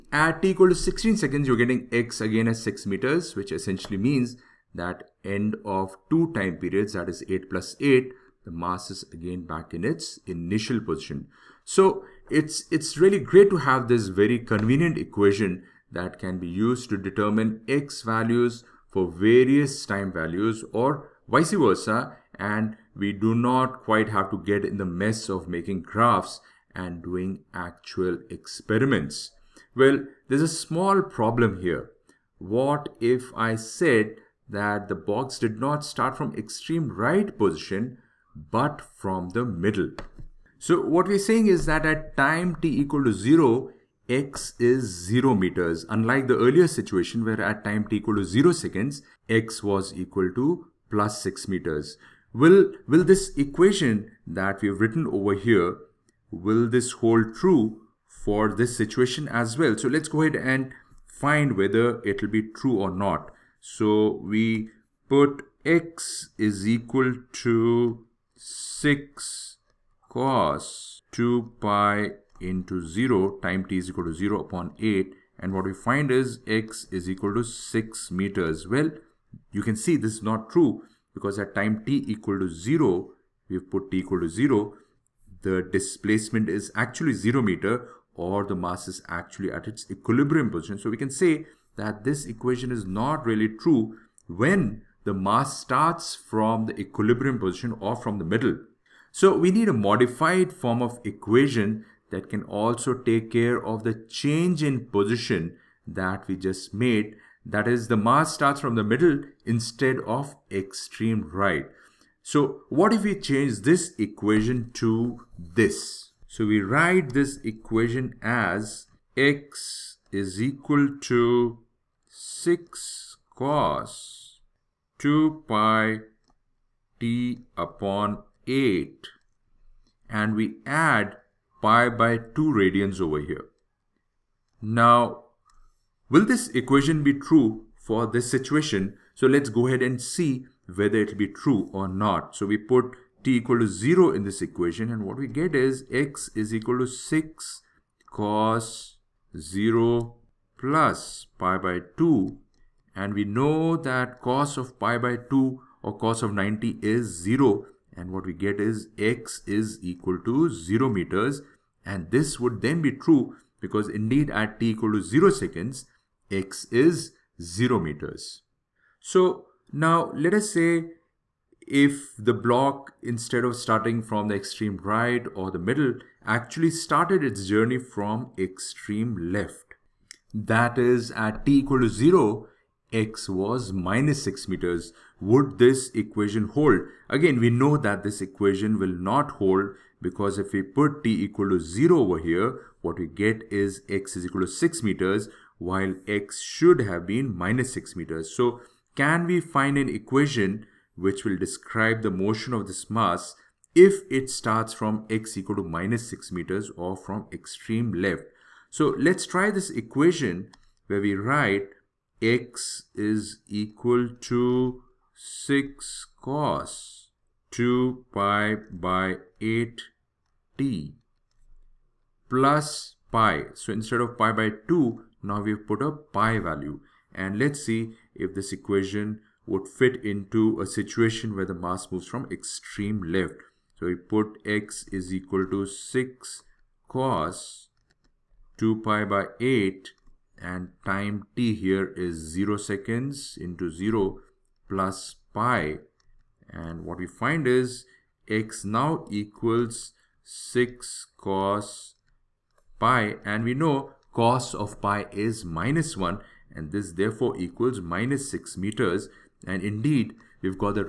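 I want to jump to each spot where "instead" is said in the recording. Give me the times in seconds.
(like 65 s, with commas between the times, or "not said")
109 s, 173 s, 223 s.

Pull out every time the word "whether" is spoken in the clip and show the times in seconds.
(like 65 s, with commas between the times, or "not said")
61 s, 140 s.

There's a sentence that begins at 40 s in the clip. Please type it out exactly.
So what we're saying is that at time t equal to 0, x is 0 meters.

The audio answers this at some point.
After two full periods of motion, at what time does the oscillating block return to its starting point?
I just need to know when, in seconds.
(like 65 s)
0 s.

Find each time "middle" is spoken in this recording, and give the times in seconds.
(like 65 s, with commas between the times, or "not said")
39 s, 98 s, 108 s, 175 s.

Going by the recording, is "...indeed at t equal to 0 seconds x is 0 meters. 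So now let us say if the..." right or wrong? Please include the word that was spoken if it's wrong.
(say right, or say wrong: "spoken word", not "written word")
right.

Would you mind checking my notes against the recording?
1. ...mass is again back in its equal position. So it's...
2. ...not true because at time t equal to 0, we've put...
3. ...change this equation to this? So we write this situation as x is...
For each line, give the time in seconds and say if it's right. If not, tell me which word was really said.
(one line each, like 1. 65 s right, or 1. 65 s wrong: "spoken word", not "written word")
1. 8 s wrong: "initial", not "equal"
2. 80 s right
3. 113 s wrong: "equation", not "situation".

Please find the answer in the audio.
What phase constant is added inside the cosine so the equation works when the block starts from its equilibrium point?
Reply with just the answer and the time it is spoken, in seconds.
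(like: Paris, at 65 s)
pi/2 radians, at 131 s.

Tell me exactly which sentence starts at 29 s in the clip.
Well, there's a small problem here.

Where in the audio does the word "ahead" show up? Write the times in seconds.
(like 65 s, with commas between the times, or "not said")
60 s, 139 s.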